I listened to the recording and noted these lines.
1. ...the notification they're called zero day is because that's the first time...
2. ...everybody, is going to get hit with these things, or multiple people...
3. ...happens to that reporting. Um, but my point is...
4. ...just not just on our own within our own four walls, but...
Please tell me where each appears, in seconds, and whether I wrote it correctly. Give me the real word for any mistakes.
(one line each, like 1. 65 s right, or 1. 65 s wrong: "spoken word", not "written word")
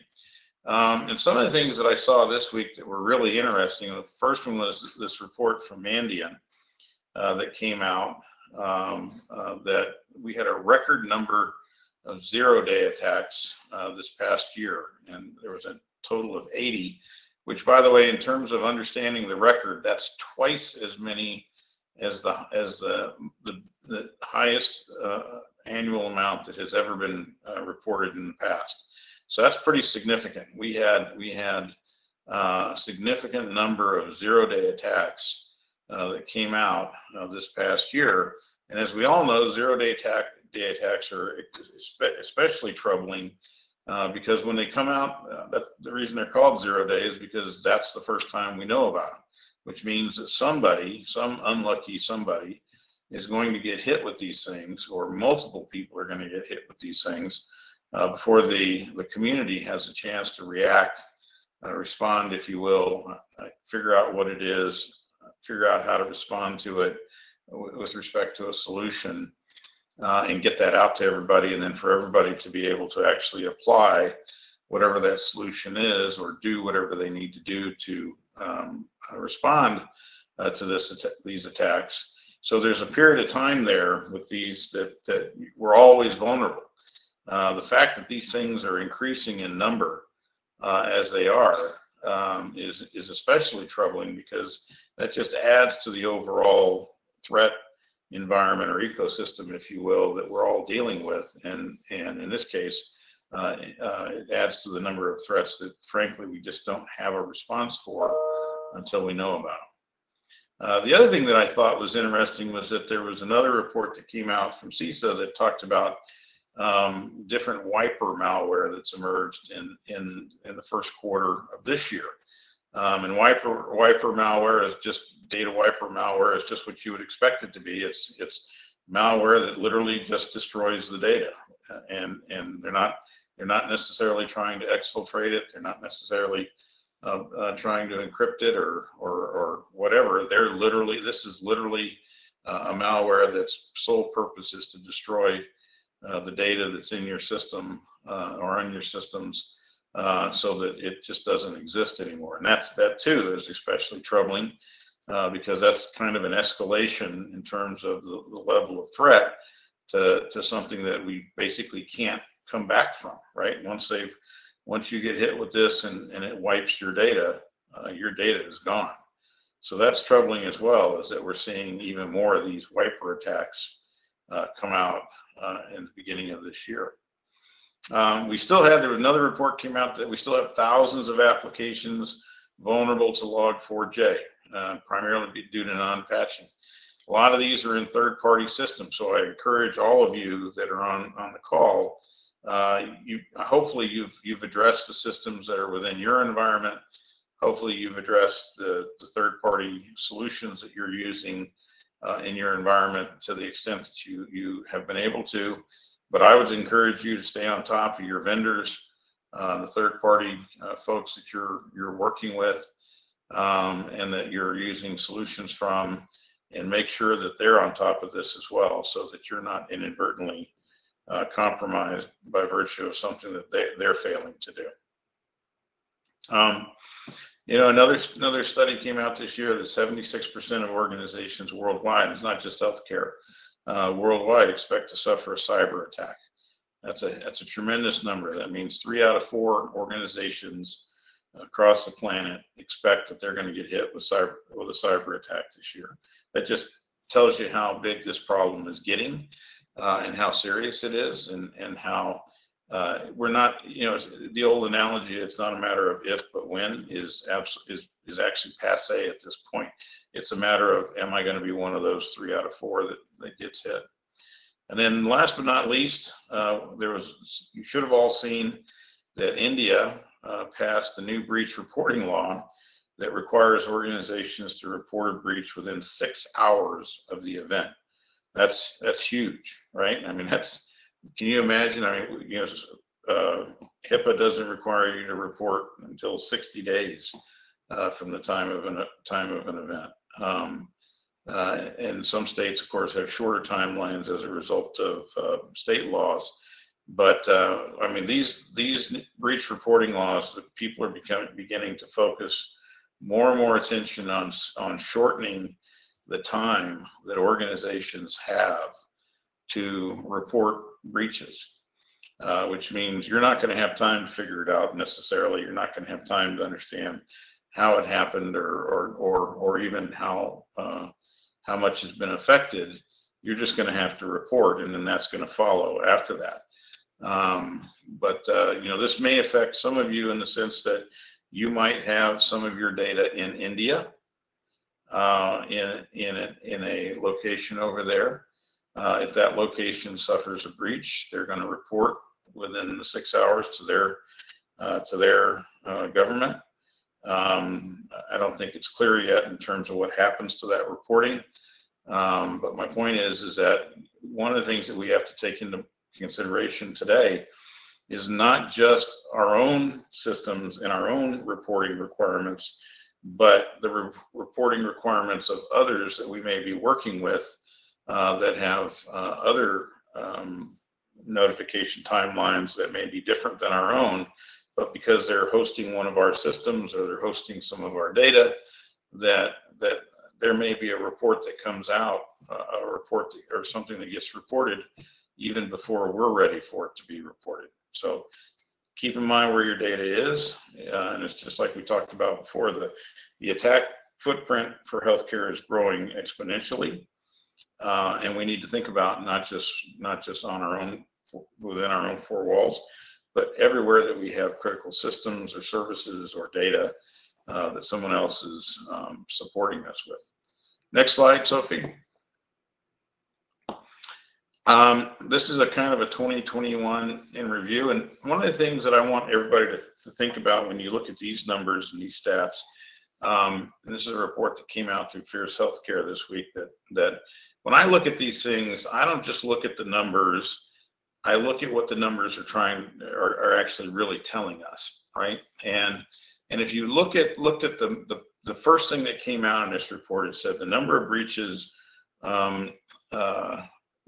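1. 45 s wrong: "reason", not "notification"
2. 51 s wrong: "somebody", not "everybody"
3. 349 s right
4. 399 s right.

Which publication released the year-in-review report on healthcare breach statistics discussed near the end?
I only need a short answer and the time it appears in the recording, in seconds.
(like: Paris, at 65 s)
Fierce Healthcare, at 425 s.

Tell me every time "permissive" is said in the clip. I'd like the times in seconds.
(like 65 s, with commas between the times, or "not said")
not said.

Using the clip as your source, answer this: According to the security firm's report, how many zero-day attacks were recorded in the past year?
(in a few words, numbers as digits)
80.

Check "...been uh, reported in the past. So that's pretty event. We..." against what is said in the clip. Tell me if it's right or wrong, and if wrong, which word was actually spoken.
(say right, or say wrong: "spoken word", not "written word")
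wrong: "significant", not "event".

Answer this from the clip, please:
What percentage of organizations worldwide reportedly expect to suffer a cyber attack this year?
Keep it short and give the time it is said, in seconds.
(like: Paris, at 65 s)
76%, at 229 s.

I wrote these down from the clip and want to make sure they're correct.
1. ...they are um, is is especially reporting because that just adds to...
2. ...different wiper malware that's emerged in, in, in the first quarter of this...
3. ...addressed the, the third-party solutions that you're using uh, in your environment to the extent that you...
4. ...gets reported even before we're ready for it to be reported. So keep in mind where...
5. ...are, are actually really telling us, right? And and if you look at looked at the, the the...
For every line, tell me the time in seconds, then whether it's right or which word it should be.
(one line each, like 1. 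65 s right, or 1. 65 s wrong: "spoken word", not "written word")
1. 91 s wrong: "troubling", not "reporting"
2. 117 s right
3. 197 s right
4. 383 s right
5. 432 s right.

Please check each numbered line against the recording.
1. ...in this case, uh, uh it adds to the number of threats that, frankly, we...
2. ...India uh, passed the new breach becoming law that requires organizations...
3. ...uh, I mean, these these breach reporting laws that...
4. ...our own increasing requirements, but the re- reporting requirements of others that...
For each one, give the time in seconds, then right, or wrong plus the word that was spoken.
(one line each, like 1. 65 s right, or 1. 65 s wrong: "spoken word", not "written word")
1. 102 s right
2. 269 s wrong: "reporting", not "becoming"
3. 297 s right
4. 360 s wrong: "reporting", not "increasing".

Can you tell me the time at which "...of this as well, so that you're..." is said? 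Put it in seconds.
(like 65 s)
218 s.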